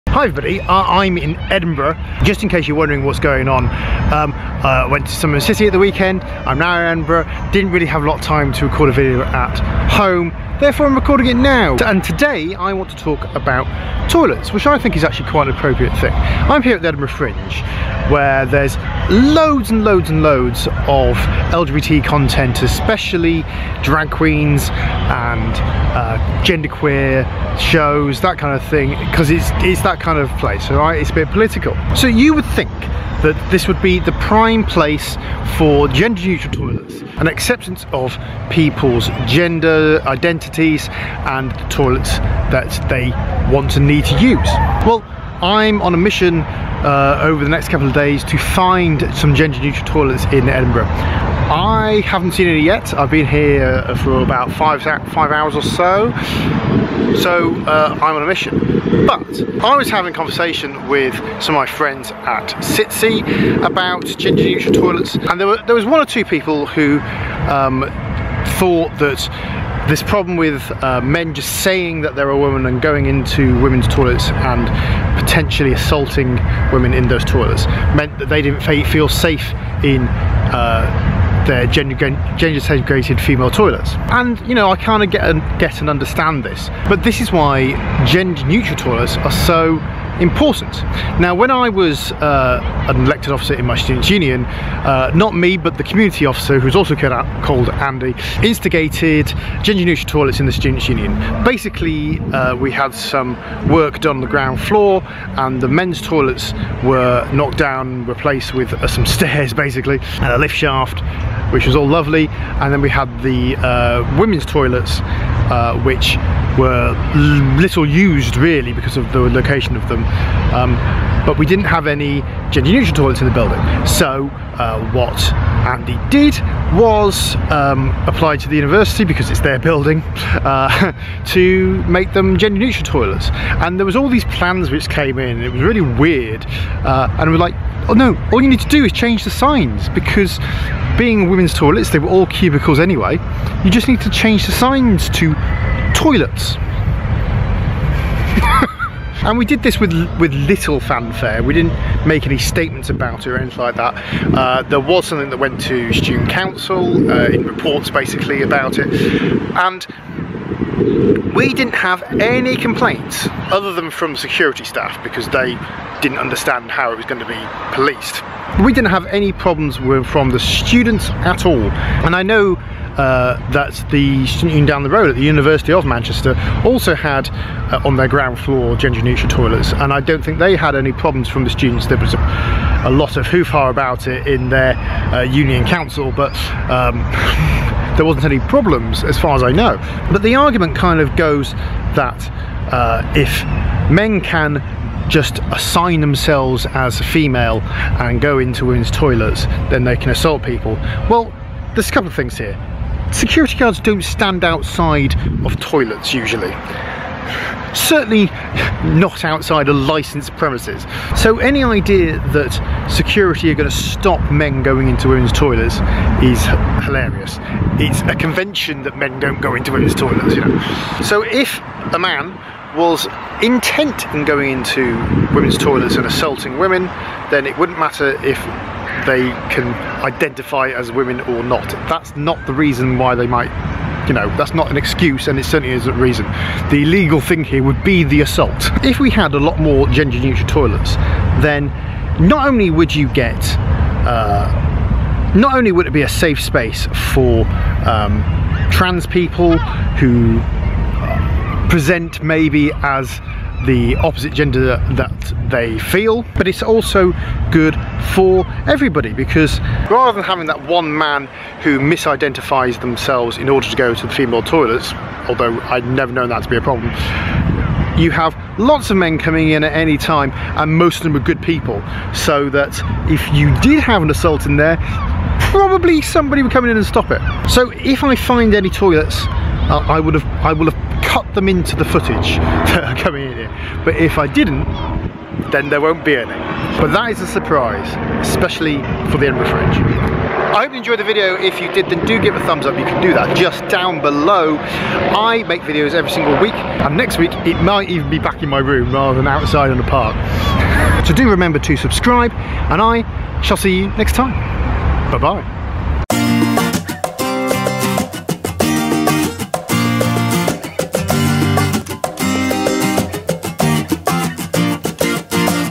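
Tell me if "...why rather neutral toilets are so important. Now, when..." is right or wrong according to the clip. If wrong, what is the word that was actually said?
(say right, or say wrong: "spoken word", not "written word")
wrong: "gender", not "rather".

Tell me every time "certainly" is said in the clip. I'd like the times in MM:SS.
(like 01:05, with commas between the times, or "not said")
03:27, 03:55.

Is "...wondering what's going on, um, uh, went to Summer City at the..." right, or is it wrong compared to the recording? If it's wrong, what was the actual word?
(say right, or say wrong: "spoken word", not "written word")
right.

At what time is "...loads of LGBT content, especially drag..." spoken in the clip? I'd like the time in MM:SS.
00:20.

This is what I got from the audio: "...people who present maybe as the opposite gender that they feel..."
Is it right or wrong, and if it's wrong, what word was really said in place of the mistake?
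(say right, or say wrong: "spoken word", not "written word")
right.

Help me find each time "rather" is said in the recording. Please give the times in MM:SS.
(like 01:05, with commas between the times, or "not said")
04:19, 04:58.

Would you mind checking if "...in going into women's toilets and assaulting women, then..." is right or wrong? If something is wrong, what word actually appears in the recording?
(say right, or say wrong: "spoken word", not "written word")
right.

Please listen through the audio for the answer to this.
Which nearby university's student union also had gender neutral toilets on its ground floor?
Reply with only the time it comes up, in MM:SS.
02:55.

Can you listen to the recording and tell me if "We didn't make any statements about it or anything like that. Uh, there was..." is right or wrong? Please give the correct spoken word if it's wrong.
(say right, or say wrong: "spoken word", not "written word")
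right.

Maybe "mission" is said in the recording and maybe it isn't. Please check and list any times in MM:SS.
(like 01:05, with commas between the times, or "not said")
00:45, 00:58.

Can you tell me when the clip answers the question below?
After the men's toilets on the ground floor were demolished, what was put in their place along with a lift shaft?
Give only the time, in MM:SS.
01:49.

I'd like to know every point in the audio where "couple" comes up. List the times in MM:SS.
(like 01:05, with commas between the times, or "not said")
00:47, 03:21.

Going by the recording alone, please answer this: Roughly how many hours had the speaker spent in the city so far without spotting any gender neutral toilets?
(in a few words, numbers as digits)
5.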